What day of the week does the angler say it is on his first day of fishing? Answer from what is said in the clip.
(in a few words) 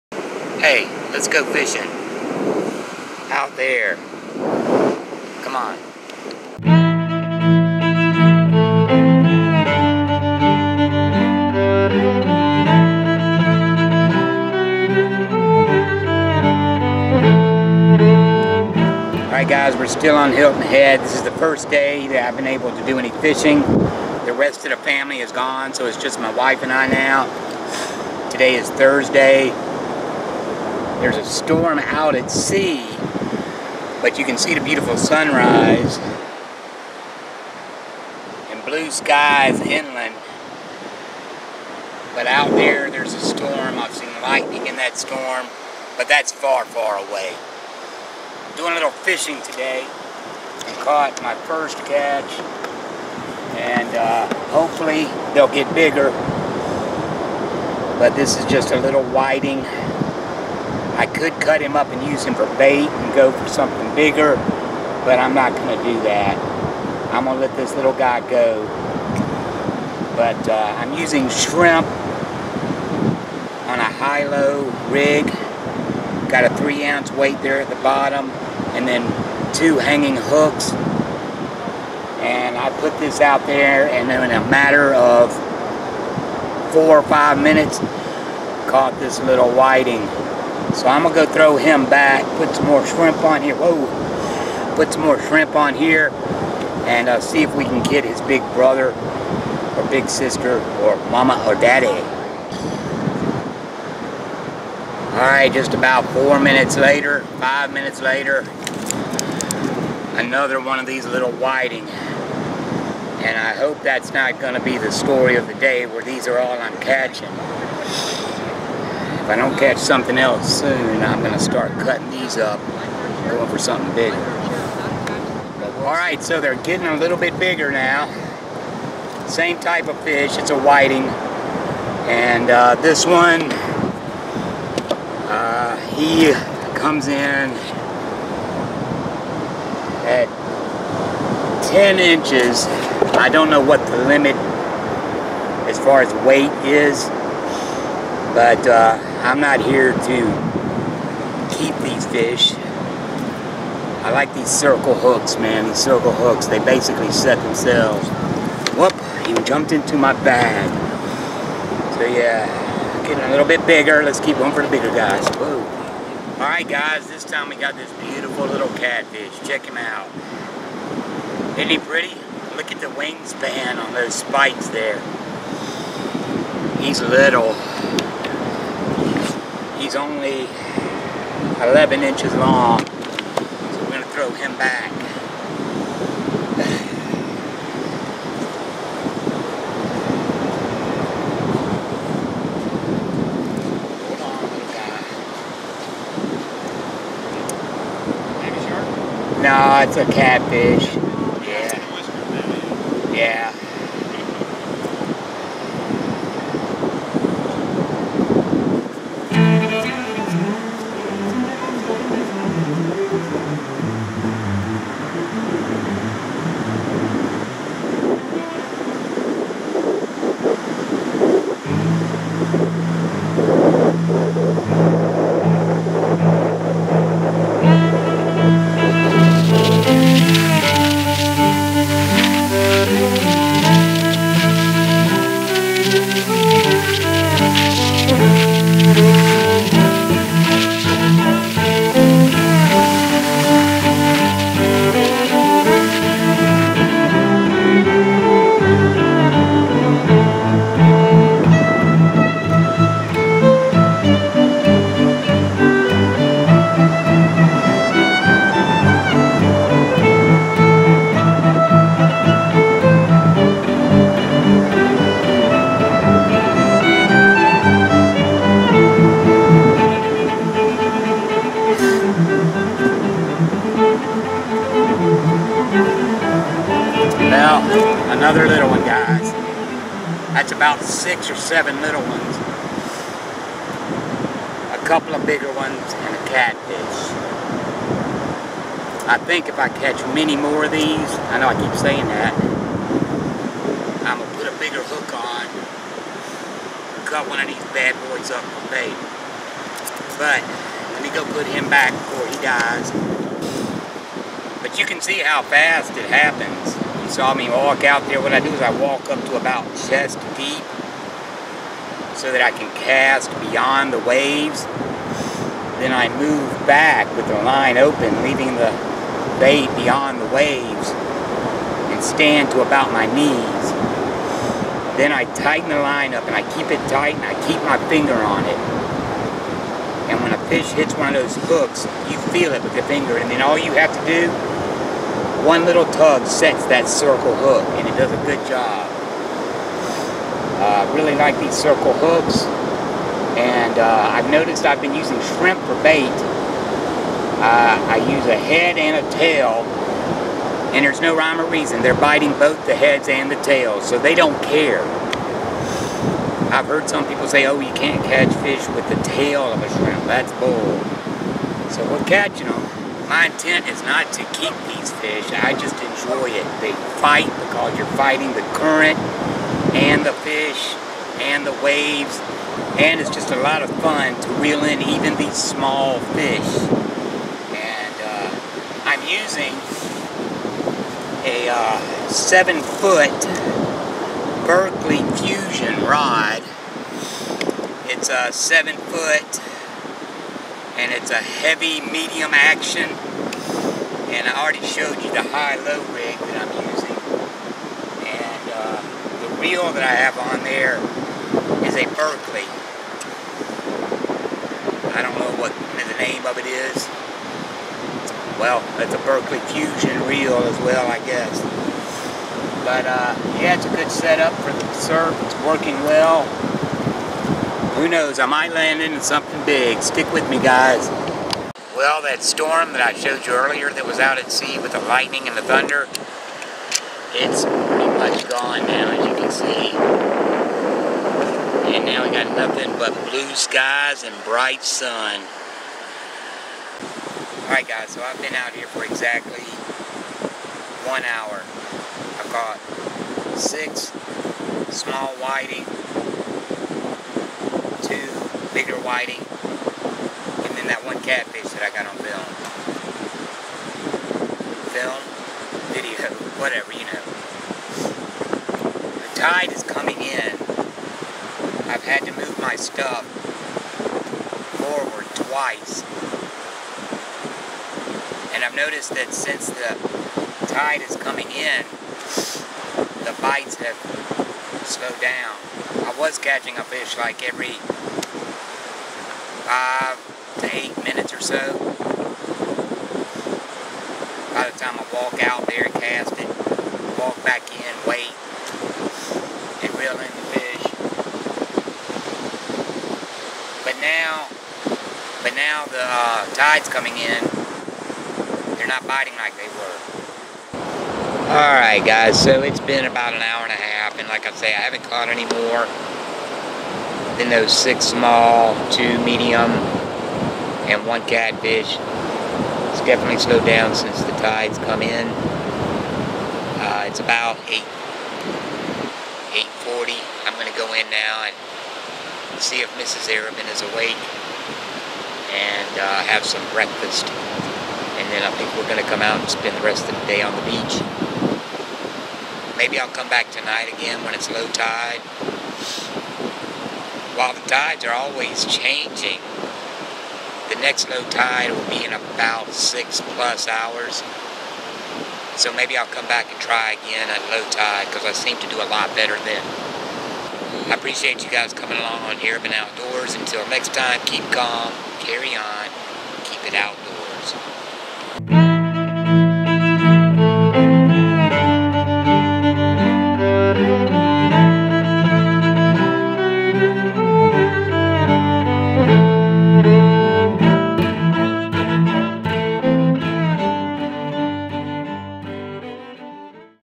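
Thursday.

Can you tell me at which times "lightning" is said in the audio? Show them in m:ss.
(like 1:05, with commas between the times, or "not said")
0:44, 7:04.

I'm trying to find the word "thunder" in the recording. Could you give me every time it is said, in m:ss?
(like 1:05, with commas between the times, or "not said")
7:05.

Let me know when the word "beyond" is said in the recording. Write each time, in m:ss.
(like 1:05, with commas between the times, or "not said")
5:13, 5:19.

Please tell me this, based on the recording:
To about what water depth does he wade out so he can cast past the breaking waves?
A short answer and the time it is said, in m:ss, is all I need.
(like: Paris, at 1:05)
chest deep, at 5:09.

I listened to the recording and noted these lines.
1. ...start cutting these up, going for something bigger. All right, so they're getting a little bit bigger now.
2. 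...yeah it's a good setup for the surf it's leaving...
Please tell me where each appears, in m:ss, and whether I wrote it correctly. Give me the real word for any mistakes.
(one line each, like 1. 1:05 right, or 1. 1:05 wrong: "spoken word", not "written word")
1. 2:01 right
2. 6:53 wrong: "working", not "leaving".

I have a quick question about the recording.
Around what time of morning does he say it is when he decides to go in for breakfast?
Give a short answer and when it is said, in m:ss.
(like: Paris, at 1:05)
8:40, at 8:39.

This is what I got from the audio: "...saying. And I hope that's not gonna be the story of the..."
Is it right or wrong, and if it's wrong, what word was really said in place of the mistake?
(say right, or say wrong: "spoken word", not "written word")
wrong: "whiting", not "saying".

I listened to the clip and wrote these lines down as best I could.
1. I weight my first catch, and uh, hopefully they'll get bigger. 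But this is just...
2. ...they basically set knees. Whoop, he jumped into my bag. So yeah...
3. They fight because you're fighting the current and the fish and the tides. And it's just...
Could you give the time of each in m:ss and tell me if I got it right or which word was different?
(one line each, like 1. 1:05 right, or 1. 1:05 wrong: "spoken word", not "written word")
1. 0:49 wrong: "caught", not "weight"
2. 2:36 wrong: "themselves", not "knees"
3. 6:06 wrong: "waves", not "tides".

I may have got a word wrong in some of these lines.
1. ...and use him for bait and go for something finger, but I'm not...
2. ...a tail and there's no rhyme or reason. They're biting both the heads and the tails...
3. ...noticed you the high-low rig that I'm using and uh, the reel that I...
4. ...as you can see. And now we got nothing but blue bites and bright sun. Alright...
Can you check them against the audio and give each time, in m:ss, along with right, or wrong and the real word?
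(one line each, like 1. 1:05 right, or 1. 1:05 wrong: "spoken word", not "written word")
1. 1:01 wrong: "bigger", not "finger"
2. 5:49 right
3. 6:34 wrong: "showed", not "noticed"
4. 7:08 wrong: "skies", not "bites".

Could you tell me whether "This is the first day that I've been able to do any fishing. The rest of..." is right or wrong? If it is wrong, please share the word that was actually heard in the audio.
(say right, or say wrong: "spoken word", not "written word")
right.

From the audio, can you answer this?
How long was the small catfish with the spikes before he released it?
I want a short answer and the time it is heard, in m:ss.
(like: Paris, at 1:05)
11 inches, at 3:01.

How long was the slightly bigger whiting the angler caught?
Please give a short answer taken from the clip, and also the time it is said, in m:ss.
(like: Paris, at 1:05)
10 inches, at 2:21.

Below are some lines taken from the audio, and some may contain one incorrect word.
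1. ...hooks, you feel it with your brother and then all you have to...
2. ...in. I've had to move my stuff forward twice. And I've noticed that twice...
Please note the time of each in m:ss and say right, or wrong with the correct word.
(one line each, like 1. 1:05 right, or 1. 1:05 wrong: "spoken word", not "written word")
1. 5:31 wrong: "finger", not "brother"
2. 7:40 wrong: "since", not "twice".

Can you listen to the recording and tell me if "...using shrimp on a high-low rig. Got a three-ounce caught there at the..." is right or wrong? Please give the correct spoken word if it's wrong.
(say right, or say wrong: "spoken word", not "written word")
wrong: "weight", not "caught".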